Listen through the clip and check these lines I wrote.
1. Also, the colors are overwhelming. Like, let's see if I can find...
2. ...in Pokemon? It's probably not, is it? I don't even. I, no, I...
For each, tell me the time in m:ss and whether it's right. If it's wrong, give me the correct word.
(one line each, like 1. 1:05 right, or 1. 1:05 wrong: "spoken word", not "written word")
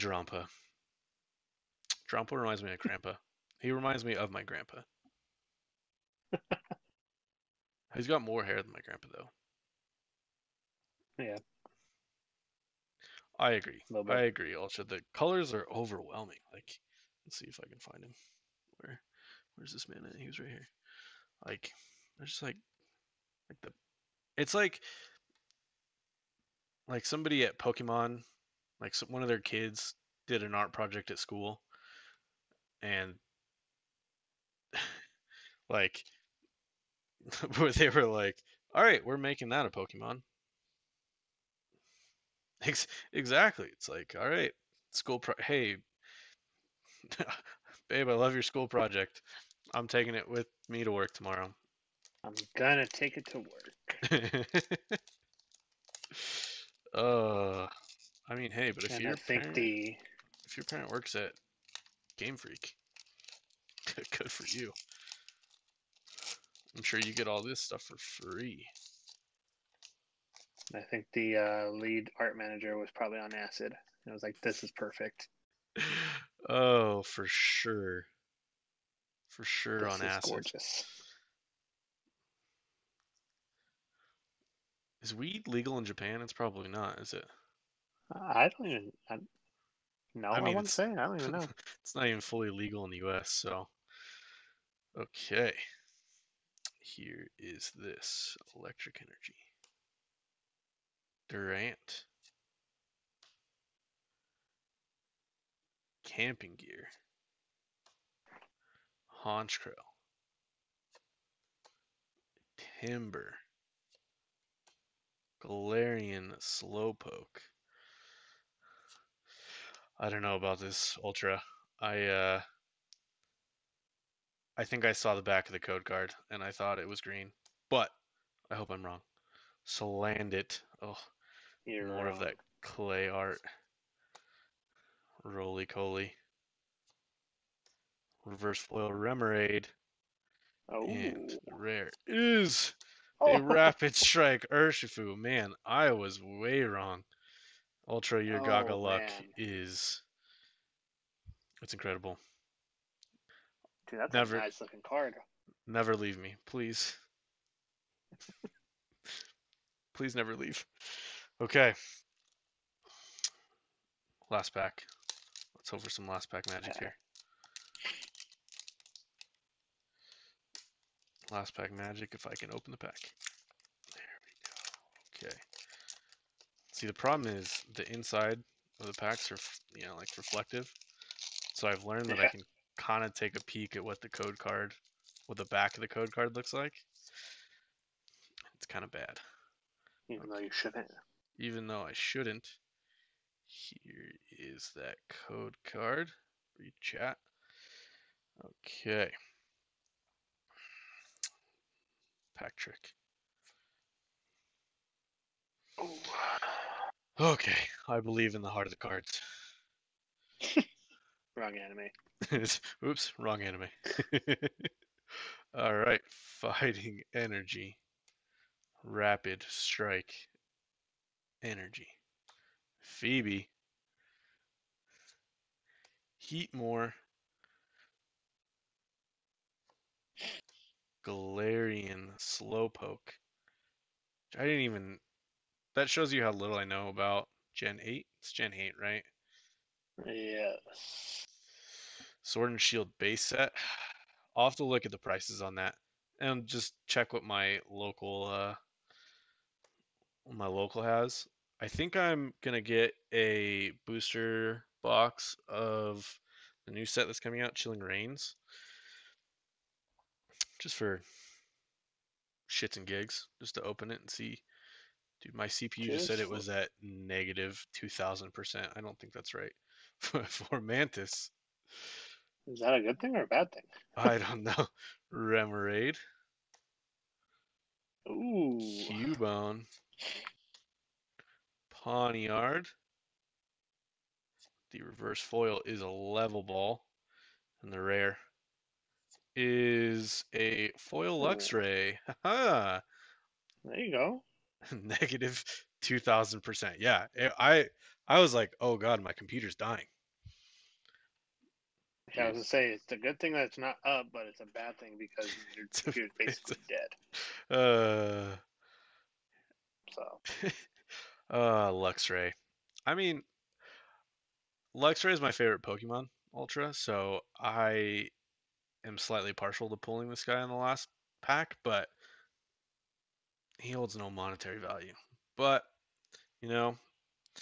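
1. 0:14 right
2. 1:25 wrong: "Japan", not "Pokemon".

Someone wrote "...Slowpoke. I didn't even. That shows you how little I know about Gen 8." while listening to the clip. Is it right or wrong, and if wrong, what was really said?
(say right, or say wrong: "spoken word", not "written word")
right.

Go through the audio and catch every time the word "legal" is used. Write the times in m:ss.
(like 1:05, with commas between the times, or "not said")
1:25, 1:32.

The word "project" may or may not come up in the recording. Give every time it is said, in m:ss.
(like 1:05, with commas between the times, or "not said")
0:30, 0:48.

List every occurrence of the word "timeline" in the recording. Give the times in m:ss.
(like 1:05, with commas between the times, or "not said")
not said.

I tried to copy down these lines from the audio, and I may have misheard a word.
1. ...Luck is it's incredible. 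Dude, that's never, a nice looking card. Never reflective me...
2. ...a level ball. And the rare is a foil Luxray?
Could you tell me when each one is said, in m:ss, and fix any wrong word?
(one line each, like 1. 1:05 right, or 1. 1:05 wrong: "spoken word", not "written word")
1. 2:28 wrong: "leave", not "reflective"
2. 4:45 right.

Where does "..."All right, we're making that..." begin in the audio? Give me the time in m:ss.
0:38.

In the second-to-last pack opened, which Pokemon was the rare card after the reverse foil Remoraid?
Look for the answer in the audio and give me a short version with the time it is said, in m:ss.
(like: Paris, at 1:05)
Rapid Strike Urshifu, at 2:23.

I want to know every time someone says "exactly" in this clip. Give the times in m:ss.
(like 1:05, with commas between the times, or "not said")
0:43.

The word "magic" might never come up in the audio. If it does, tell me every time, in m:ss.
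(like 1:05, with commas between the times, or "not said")
2:46, 2:51.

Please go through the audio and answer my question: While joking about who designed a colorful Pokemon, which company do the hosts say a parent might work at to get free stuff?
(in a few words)
Game Freak.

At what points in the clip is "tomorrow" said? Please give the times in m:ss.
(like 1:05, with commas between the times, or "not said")
0:51.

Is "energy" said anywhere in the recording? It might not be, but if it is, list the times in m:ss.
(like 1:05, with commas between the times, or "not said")
1:39, 3:37, 3:41.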